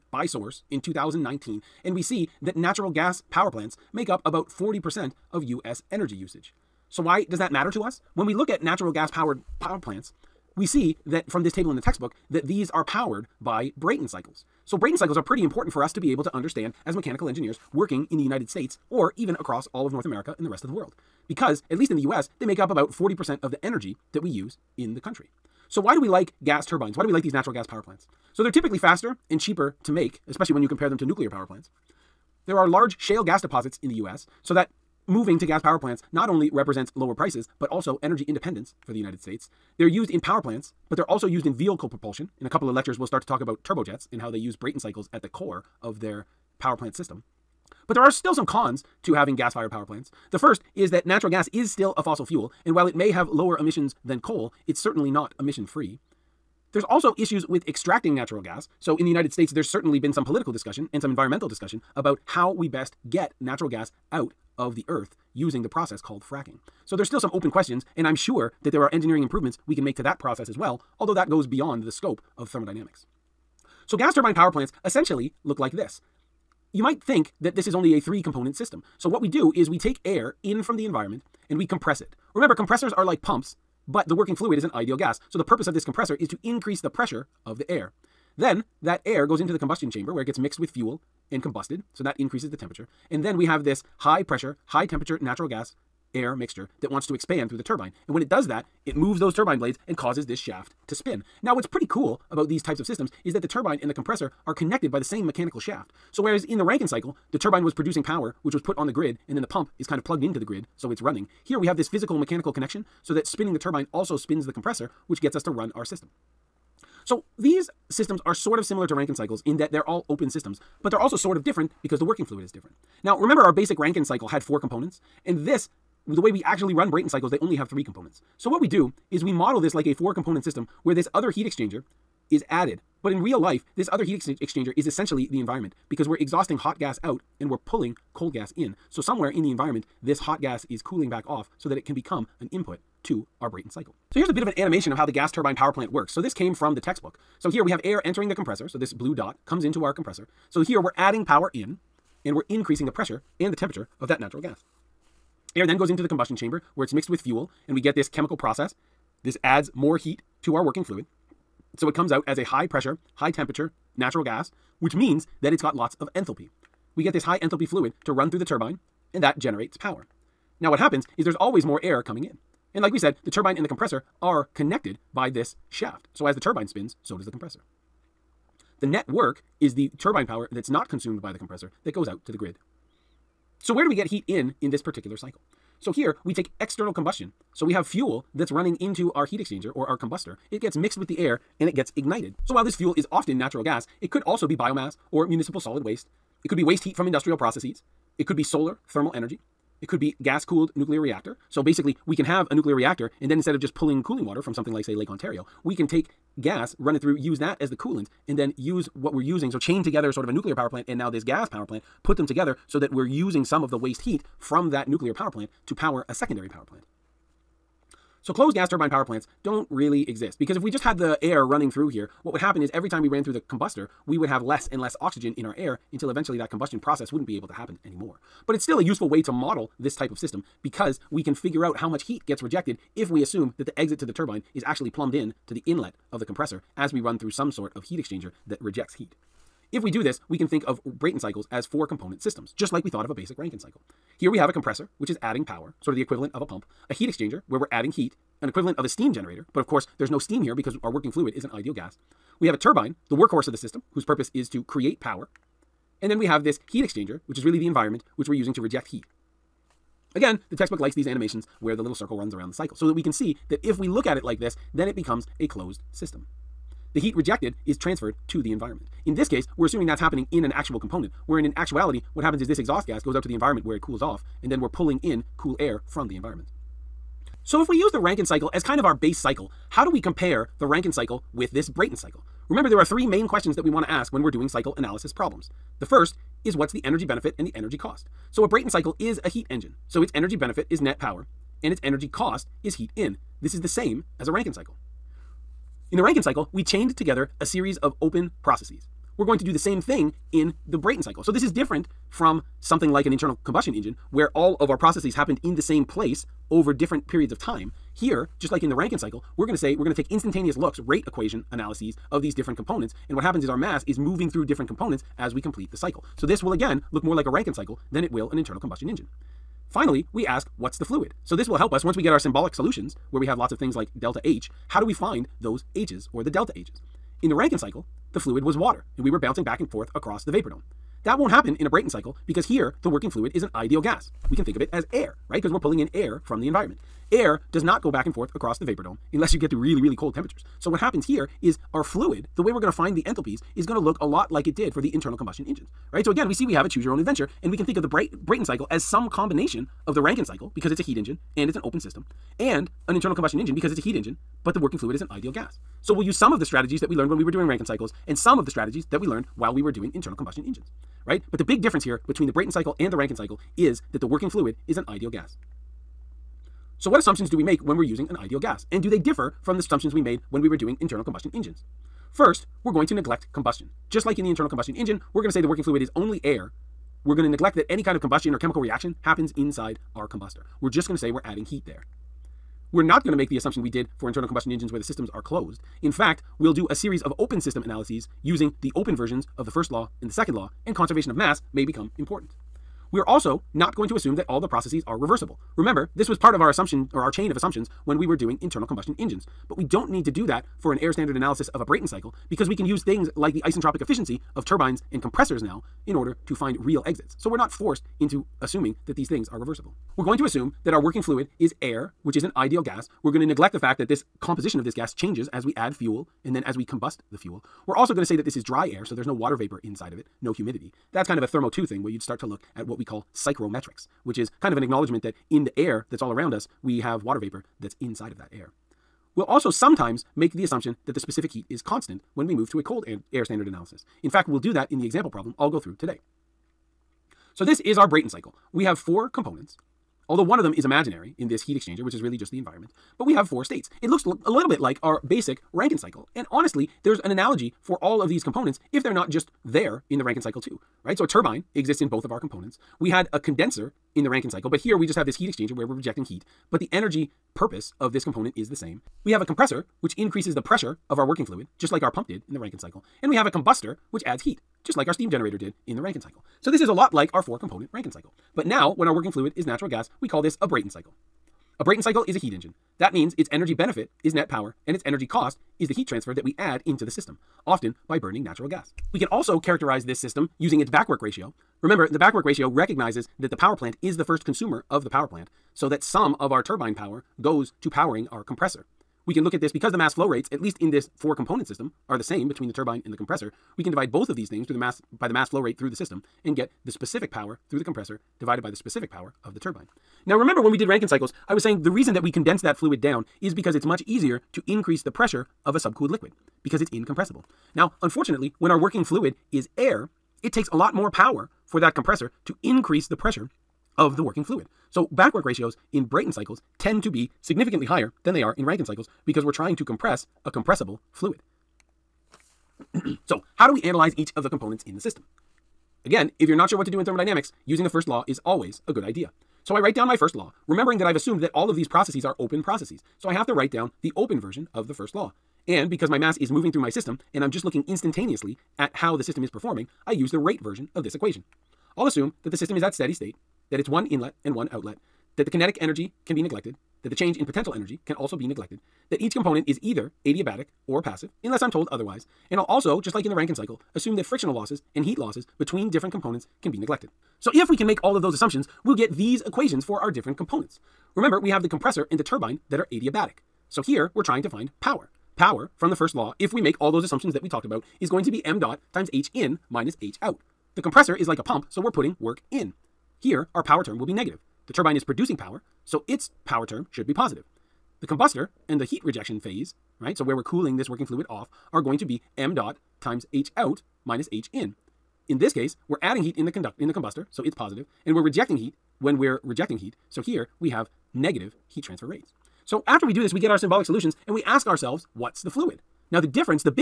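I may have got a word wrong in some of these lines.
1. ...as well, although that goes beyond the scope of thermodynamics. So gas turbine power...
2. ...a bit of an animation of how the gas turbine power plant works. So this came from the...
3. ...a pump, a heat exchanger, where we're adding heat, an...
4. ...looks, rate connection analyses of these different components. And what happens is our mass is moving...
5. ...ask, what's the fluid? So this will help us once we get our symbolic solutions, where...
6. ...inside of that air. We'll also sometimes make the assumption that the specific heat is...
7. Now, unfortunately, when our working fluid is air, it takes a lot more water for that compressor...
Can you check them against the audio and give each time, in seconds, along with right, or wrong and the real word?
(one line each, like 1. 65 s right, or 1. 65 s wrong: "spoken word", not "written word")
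1. 70 s right
2. 144 s right
3. 246 s right
4. 310 s wrong: "equation", not "connection"
5. 320 s right
6. 427 s right
7. 507 s wrong: "power", not "water".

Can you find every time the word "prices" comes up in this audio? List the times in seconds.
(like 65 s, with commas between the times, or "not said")
37 s.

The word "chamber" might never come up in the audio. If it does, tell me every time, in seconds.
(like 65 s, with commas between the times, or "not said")
89 s, 156 s.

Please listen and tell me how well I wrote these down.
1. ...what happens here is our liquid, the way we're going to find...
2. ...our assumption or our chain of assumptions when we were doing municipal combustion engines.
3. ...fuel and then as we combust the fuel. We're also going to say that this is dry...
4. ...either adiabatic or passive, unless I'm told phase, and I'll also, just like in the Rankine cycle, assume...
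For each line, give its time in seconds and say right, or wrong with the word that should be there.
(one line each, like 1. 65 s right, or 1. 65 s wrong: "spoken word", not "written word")
1. 340 s wrong: "fluid", not "liquid"
2. 396 s wrong: "internal", not "municipal"
3. 415 s right
4. 549 s wrong: "otherwise", not "phase".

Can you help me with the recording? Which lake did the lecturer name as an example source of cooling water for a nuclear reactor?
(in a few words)
Lake Ontario.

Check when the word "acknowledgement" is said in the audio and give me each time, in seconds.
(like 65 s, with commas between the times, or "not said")
424 s.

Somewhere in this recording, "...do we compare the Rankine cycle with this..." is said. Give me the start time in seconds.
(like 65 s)
279 s.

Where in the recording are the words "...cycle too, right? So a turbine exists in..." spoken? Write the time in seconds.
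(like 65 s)
450 s.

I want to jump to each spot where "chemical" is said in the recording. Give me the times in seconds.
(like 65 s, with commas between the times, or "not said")
158 s, 378 s.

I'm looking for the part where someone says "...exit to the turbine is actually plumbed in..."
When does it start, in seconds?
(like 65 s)
233 s.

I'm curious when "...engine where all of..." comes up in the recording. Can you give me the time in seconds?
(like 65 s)
303 s.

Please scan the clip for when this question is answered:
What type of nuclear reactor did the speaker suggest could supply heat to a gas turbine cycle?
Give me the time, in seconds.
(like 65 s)
200 s.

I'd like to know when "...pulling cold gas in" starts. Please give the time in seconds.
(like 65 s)
137 s.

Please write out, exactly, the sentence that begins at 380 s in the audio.
We're just going to say we're adding heat there.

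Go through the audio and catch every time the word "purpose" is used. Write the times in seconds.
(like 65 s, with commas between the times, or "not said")
85 s, 254 s, 457 s.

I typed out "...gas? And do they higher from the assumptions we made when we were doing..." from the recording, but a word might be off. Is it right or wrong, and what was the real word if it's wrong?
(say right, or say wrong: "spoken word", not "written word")
wrong: "differ", not "higher".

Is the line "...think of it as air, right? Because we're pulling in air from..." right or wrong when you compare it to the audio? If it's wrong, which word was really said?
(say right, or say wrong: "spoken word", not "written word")
right.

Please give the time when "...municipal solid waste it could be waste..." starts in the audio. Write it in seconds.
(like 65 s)
195 s.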